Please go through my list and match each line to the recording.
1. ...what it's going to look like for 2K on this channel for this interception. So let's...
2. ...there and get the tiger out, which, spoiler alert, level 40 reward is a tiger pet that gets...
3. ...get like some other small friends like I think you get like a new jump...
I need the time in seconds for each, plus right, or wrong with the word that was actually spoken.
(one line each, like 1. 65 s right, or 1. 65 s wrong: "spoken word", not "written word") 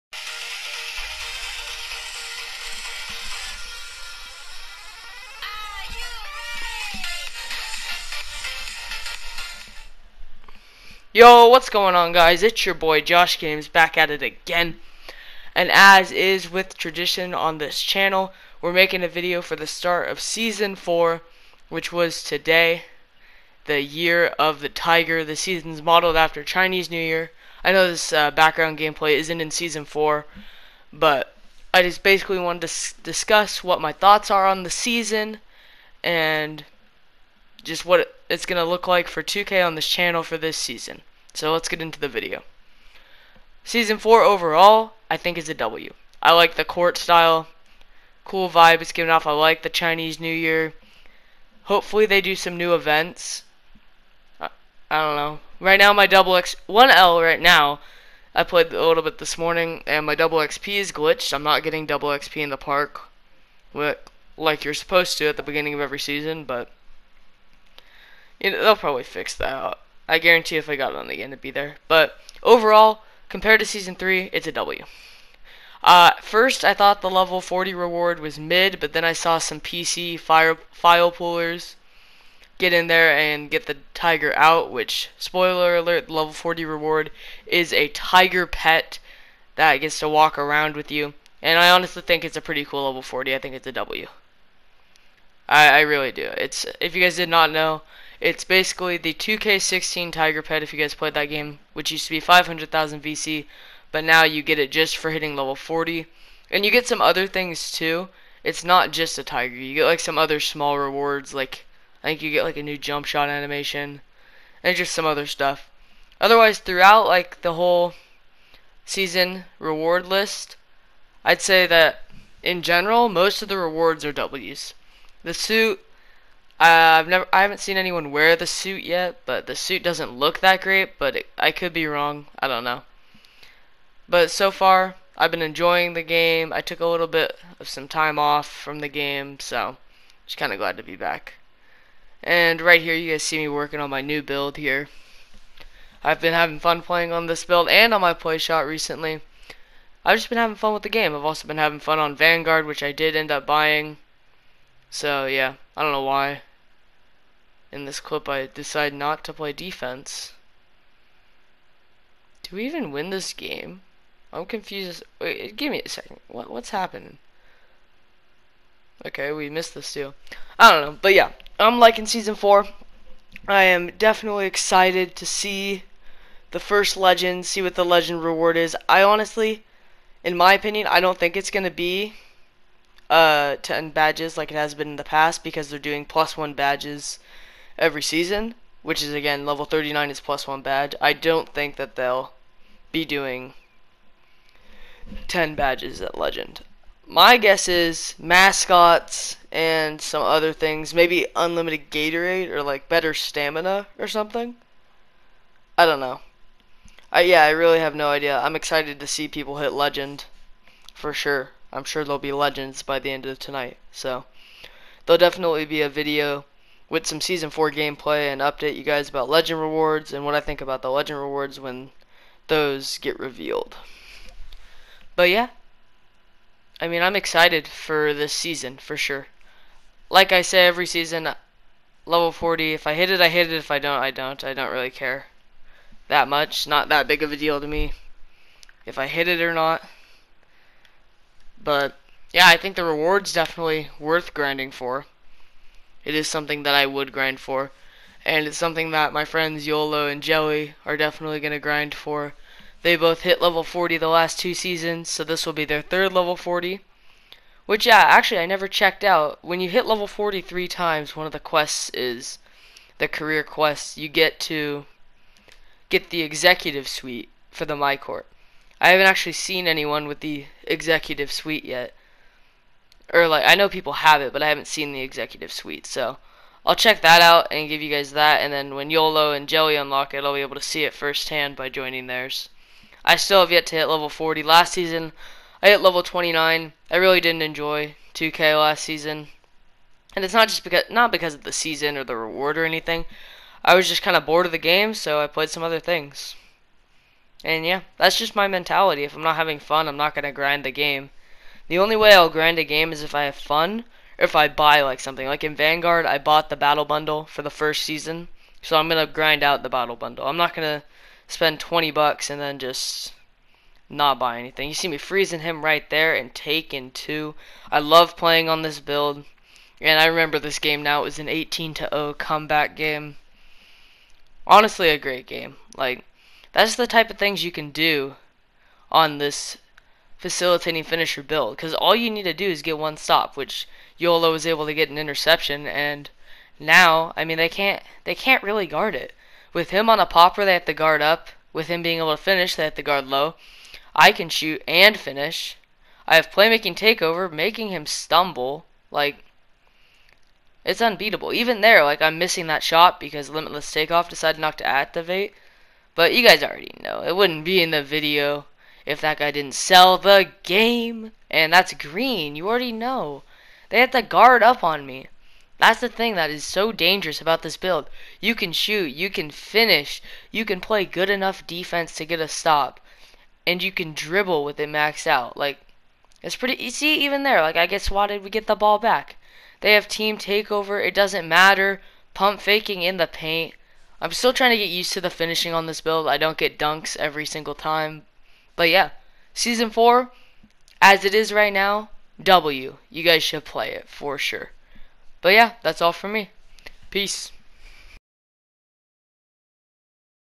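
1. 37 s wrong: "season", not "interception"
2. 82 s right
3. 109 s wrong: "rewards", not "friends".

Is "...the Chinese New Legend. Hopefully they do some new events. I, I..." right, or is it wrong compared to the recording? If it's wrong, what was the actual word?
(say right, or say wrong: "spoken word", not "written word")
wrong: "Year", not "Legend".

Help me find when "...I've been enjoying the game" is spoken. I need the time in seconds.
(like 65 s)
135 s.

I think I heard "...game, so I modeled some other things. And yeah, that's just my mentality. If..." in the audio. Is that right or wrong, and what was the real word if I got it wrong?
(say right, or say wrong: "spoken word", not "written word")
wrong: "played", not "modeled".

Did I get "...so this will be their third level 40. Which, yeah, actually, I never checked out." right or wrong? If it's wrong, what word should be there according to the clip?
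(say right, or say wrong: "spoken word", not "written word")
right.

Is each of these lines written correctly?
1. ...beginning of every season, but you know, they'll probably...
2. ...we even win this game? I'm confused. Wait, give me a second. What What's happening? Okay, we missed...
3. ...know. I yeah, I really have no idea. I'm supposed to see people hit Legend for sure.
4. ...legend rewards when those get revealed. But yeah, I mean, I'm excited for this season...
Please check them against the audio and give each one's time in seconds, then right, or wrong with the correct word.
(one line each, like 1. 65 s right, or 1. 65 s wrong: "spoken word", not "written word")
1. 65 s right
2. 162 s right
3. 205 s wrong: "excited", not "supposed"
4. 220 s right.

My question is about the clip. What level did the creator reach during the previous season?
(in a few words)
29.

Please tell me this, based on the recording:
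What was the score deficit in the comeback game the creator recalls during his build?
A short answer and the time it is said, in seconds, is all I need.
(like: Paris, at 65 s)
18 to 0, at 321 s.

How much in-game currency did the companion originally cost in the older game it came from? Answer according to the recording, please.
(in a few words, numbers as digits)
500,000 VC.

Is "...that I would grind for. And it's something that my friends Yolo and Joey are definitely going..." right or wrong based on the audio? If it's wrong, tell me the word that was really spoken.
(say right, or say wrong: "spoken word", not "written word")
right.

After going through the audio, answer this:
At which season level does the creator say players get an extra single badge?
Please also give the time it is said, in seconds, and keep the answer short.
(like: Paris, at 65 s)
39, at 189 s.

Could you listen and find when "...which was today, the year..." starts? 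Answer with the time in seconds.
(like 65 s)
21 s.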